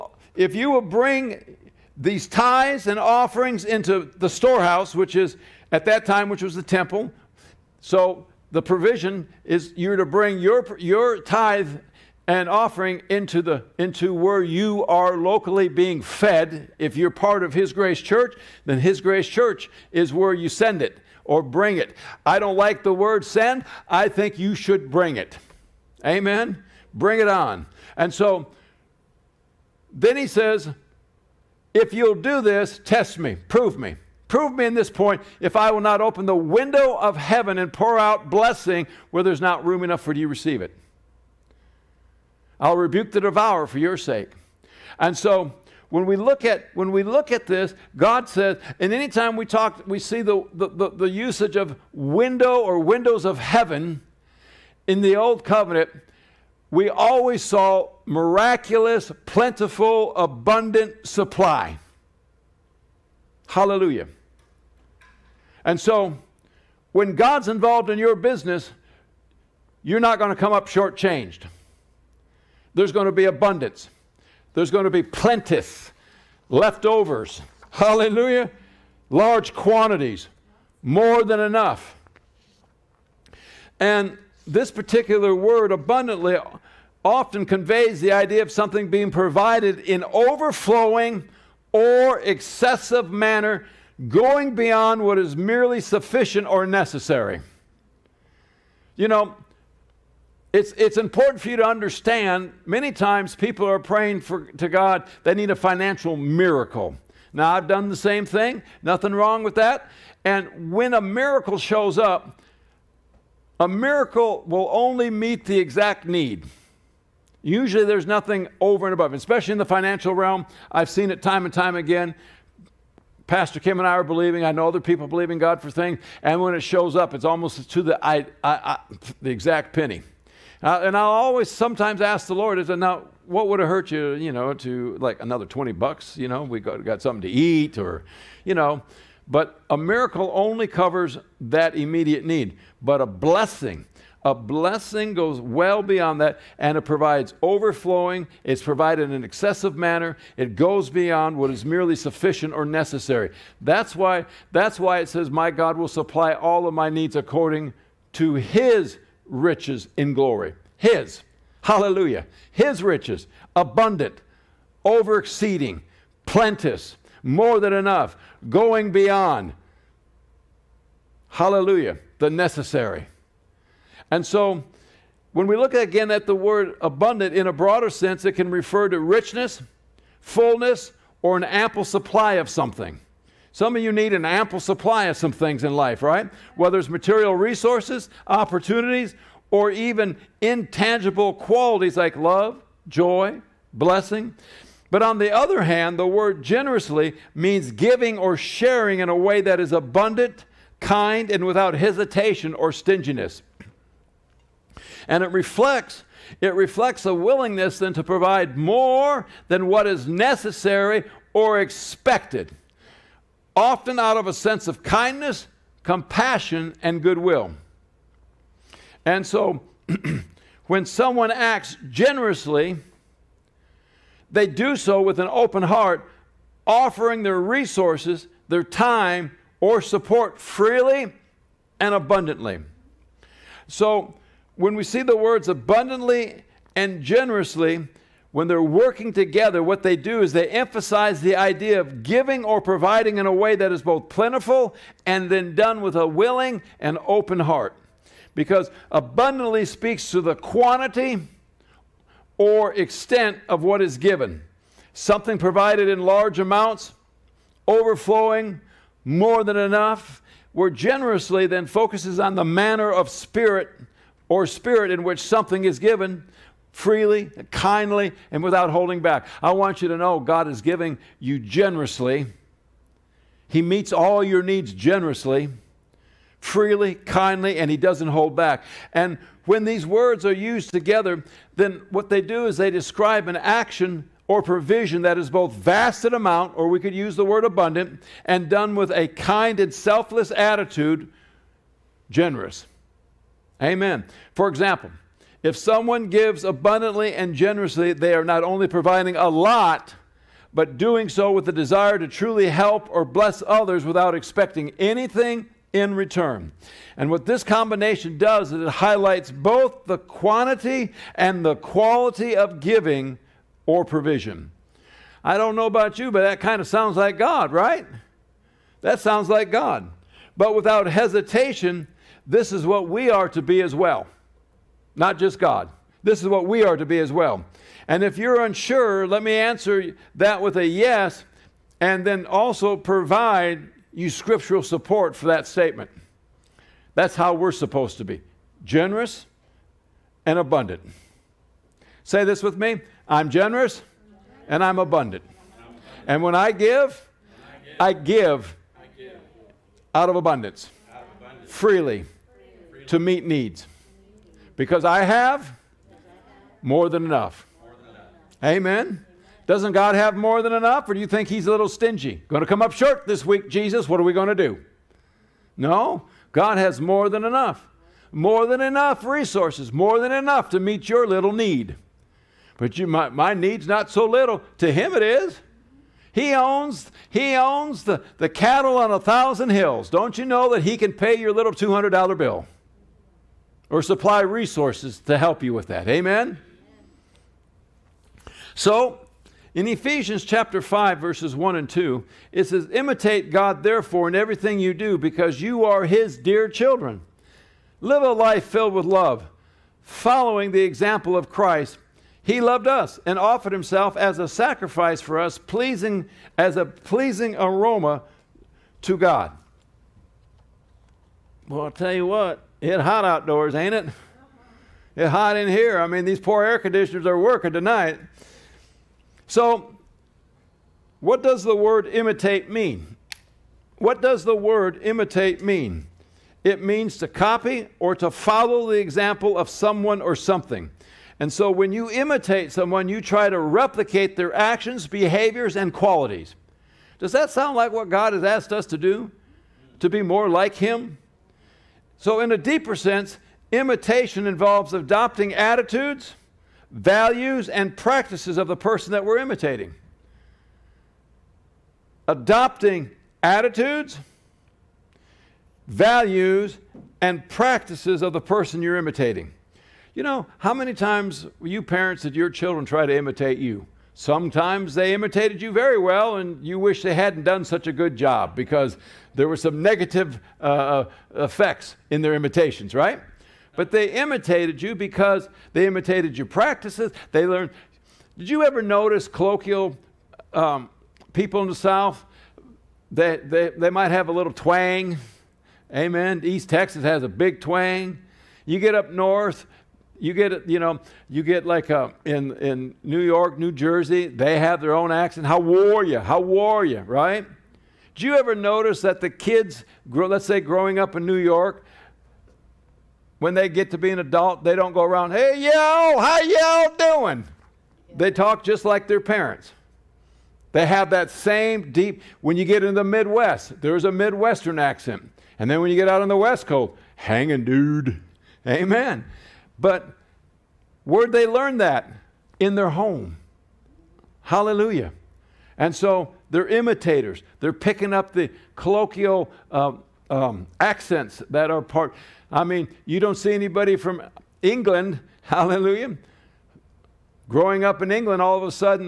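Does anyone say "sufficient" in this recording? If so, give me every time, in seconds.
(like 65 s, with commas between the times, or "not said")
95 s, 151 s.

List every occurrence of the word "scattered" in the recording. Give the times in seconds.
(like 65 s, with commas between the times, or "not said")
not said.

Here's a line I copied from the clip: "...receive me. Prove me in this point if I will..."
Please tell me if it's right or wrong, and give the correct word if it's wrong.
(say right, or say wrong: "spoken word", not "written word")
wrong: "prove", not "receive".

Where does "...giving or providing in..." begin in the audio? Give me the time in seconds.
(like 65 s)
242 s.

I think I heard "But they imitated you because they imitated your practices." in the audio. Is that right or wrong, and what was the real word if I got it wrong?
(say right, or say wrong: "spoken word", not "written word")
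right.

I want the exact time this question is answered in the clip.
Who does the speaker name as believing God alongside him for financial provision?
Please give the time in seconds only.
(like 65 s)
123 s.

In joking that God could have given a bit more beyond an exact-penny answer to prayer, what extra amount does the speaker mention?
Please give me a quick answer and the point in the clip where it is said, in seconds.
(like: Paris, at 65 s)
$20, at 135 s.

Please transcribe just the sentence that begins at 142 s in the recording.
But a blessing, a blessing goes well beyond that and it provides overflowing.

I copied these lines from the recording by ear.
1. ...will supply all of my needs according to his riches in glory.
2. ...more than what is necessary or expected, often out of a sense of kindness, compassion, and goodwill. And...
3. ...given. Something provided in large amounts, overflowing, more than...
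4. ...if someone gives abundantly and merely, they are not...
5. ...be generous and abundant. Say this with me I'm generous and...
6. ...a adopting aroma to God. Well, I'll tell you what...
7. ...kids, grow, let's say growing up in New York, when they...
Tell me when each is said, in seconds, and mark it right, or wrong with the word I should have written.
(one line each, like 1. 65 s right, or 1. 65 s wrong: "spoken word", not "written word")
1. 155 s right
2. 208 s right
3. 253 s right
4. 295 s wrong: "generously", not "merely"
5. 338 s right
6. 406 s wrong: "pleasing", not "adopting"
7. 499 s right.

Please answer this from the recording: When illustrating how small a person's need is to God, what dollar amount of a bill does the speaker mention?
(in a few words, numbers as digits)
$200.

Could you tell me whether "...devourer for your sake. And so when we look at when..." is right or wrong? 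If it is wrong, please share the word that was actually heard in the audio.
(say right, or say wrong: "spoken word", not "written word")
right.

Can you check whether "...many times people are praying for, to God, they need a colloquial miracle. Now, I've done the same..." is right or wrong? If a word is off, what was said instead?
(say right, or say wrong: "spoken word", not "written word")
wrong: "financial", not "colloquial".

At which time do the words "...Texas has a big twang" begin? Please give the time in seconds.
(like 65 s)
486 s.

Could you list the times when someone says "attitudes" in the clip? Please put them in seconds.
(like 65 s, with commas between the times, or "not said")
290 s, 445 s, 453 s.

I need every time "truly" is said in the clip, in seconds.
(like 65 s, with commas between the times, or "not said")
302 s.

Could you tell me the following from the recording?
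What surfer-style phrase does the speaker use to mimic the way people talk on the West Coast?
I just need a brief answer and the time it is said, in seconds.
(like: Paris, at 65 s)
hanging dude, at 516 s.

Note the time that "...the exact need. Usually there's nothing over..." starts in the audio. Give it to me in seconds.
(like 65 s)
115 s.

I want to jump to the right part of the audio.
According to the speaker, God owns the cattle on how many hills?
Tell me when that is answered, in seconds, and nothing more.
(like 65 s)
378 s.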